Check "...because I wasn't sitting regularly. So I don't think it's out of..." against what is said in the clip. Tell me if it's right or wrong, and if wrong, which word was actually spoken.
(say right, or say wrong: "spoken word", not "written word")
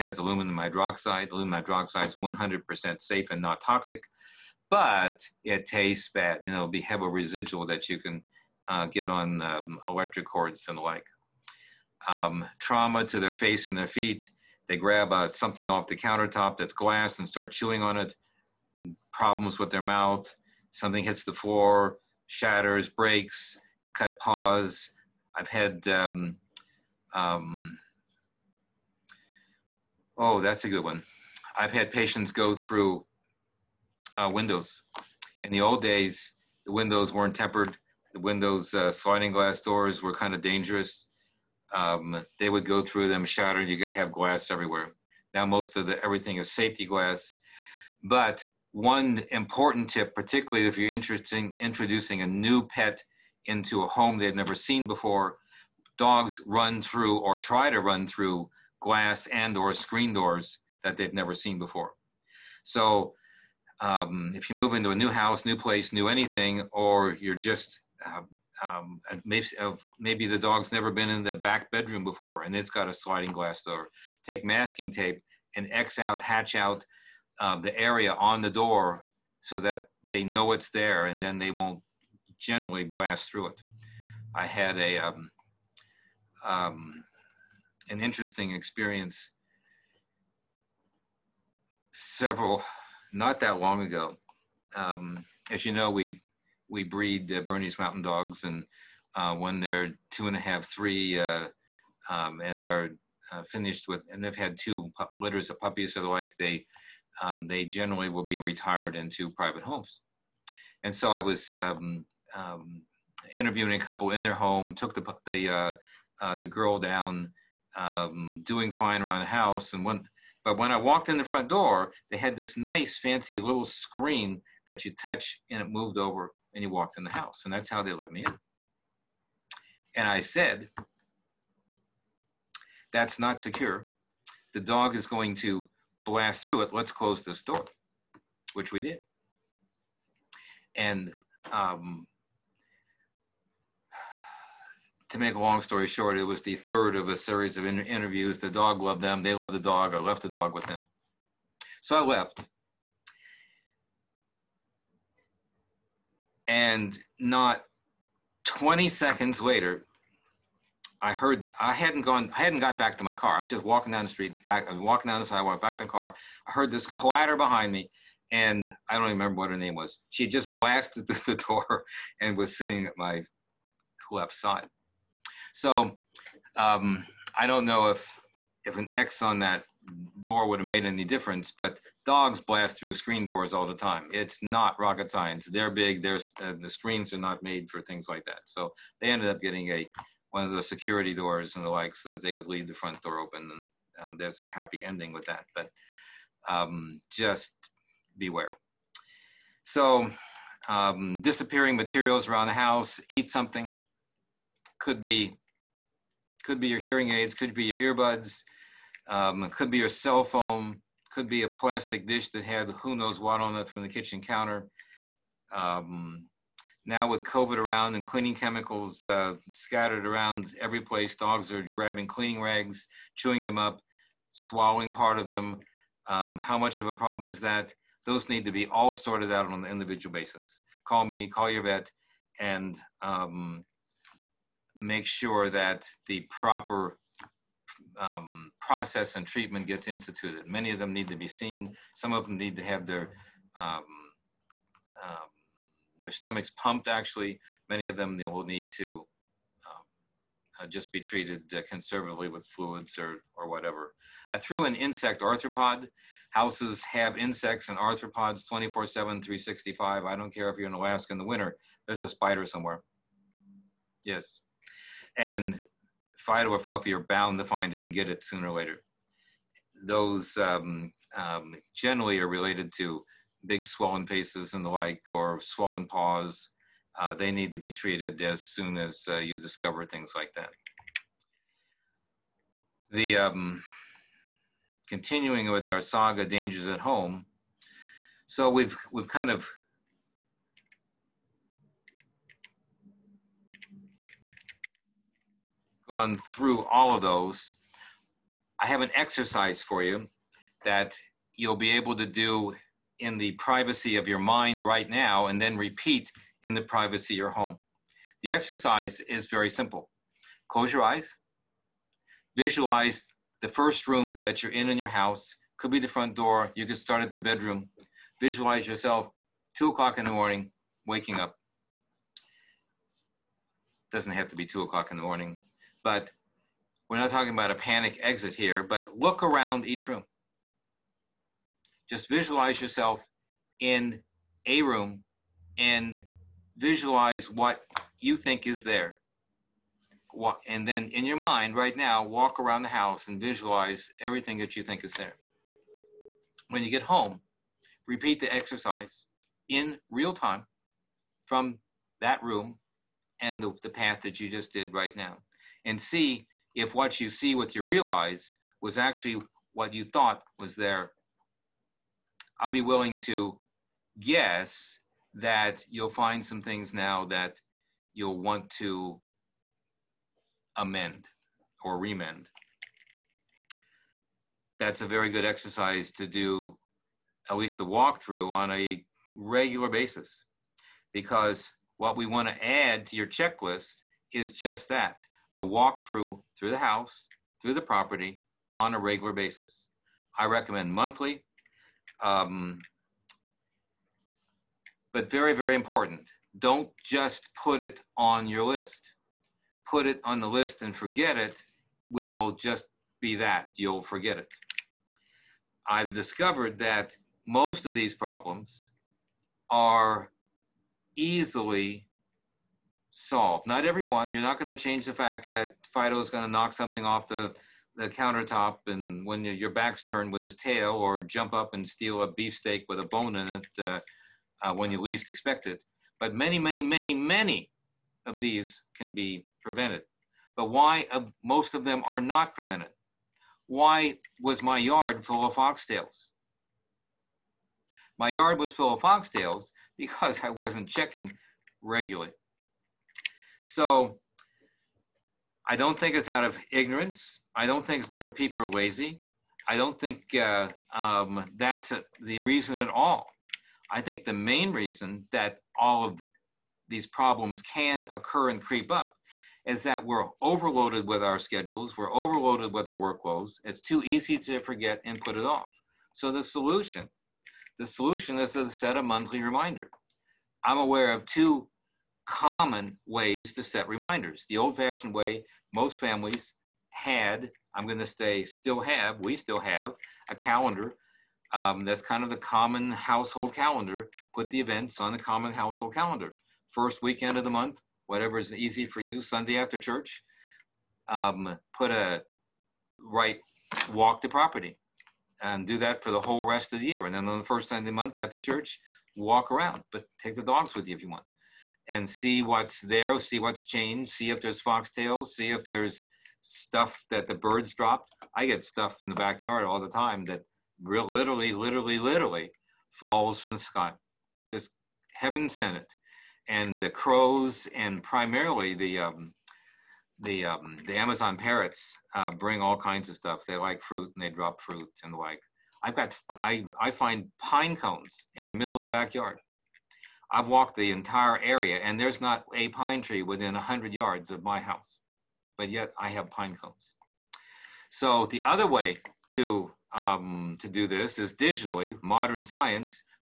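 wrong: "checking", not "sitting".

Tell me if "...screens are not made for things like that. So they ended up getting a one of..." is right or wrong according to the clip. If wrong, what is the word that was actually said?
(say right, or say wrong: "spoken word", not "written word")
right.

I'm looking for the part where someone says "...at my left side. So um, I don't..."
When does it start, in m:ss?
2:52.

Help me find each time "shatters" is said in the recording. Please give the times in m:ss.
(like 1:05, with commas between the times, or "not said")
0:22, 0:43.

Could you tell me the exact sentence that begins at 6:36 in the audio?
Don't just put it on your list.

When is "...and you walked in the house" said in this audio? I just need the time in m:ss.
2:06.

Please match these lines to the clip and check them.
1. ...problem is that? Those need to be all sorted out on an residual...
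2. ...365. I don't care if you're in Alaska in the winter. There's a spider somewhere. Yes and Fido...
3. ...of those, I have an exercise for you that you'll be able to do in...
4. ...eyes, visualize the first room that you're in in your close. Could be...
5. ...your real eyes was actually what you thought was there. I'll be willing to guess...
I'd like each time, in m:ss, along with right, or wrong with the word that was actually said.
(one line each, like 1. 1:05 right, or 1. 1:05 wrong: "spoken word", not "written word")
1. 3:46 wrong: "individual", not "residual"
2. 4:18 right
3. 4:56 right
4. 5:10 wrong: "house", not "close"
5. 5:57 right.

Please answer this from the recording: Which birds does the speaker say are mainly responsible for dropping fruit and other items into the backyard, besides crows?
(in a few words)
Amazon parrots.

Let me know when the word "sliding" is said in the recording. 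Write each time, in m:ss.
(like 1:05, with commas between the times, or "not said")
0:38, 1:12.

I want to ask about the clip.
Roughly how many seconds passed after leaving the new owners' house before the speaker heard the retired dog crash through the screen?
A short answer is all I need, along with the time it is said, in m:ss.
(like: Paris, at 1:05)
20, at 2:38.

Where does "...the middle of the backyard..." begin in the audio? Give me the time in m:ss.
8:48.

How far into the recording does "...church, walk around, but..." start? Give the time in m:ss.
8:18.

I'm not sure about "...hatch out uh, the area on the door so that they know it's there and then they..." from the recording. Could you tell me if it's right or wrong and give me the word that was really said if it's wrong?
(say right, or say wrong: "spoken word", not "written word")
right.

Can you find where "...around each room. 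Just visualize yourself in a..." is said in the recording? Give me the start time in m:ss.
5:29.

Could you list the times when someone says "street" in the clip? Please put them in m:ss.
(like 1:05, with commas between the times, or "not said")
2:44.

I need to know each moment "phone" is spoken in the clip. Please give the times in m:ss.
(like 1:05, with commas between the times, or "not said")
3:30.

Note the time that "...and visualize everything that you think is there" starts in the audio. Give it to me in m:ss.
5:43.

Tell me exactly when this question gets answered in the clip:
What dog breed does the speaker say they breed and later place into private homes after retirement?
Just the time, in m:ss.
1:37.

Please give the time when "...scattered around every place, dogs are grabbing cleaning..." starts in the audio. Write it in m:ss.
3:39.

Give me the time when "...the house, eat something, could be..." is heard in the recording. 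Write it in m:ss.
3:22.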